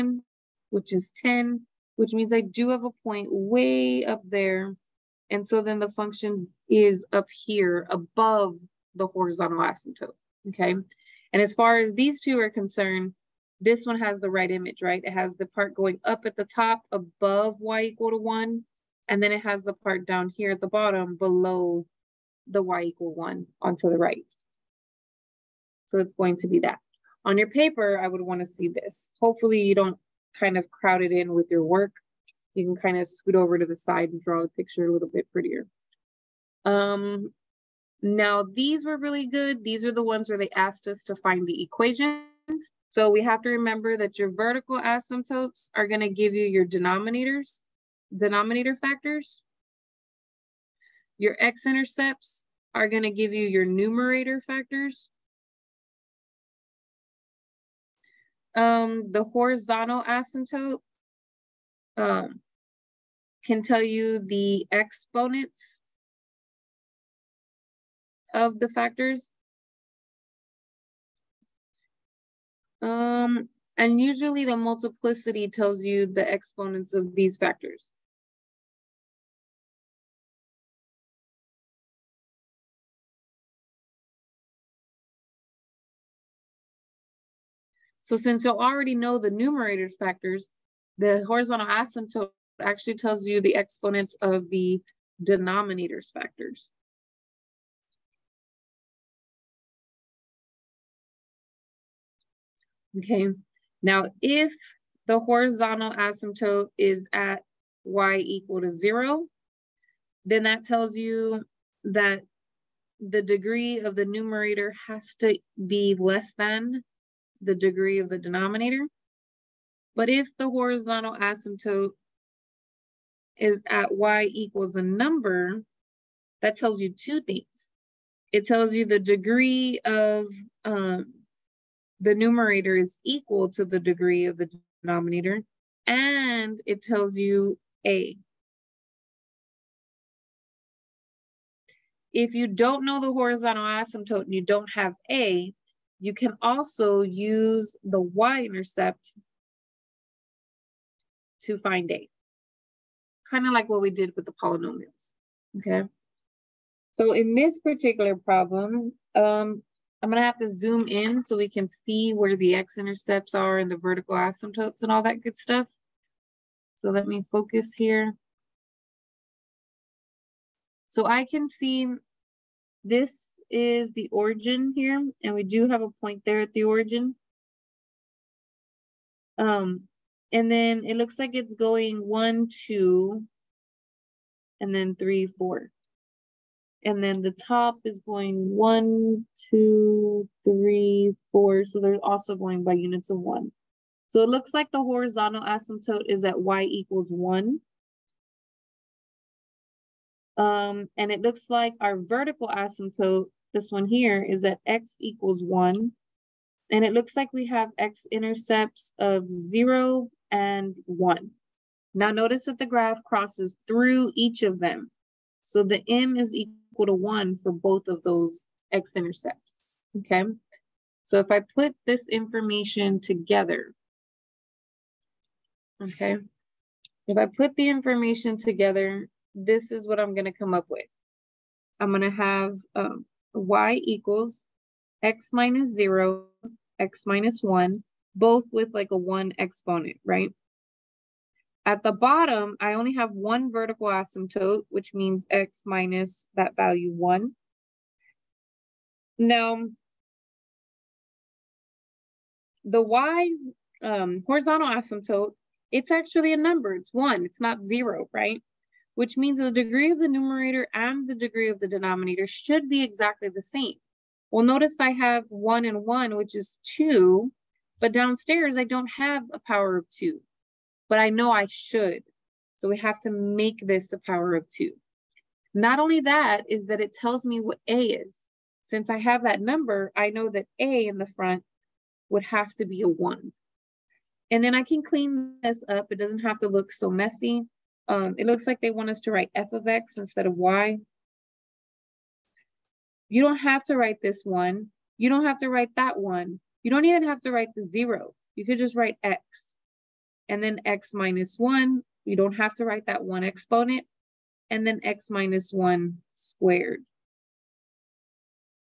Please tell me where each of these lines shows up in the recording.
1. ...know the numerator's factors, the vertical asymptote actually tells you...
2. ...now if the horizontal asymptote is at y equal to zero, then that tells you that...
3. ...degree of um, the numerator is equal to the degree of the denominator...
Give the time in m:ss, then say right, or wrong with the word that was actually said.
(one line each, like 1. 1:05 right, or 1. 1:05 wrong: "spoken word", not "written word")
1. 1:28 wrong: "horizontal", not "vertical"
2. 1:43 right
3. 2:08 right.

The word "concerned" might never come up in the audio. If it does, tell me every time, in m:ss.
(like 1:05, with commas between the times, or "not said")
0:12.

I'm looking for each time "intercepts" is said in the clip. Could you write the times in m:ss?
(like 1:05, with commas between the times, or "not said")
0:51, 2:27, 2:42, 3:27, 3:38.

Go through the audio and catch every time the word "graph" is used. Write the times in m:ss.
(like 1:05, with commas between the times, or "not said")
3:32.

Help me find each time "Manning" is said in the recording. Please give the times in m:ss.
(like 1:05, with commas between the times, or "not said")
not said.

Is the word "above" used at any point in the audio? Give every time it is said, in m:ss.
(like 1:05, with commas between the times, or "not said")
0:07, 0:16.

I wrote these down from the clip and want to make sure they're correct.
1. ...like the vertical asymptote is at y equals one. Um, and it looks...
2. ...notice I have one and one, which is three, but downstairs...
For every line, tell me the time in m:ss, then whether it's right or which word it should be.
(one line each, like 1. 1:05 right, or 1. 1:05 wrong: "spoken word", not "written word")
1. 3:14 wrong: "horizontal", not "vertical"
2. 4:24 wrong: "two", not "three".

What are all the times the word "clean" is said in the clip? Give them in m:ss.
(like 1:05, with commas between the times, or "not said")
4:44.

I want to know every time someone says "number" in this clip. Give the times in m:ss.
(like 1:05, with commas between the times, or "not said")
2:04, 4:16, 4:39.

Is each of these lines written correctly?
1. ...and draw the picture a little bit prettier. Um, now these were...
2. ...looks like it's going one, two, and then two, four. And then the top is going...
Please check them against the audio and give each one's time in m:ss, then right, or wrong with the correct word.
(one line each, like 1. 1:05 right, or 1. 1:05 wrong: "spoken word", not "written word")
1. 0:34 right
2. 3:00 wrong: "three", not "two".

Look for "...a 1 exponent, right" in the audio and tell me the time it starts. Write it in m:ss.
3:58.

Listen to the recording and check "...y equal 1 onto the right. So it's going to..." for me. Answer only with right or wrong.
right.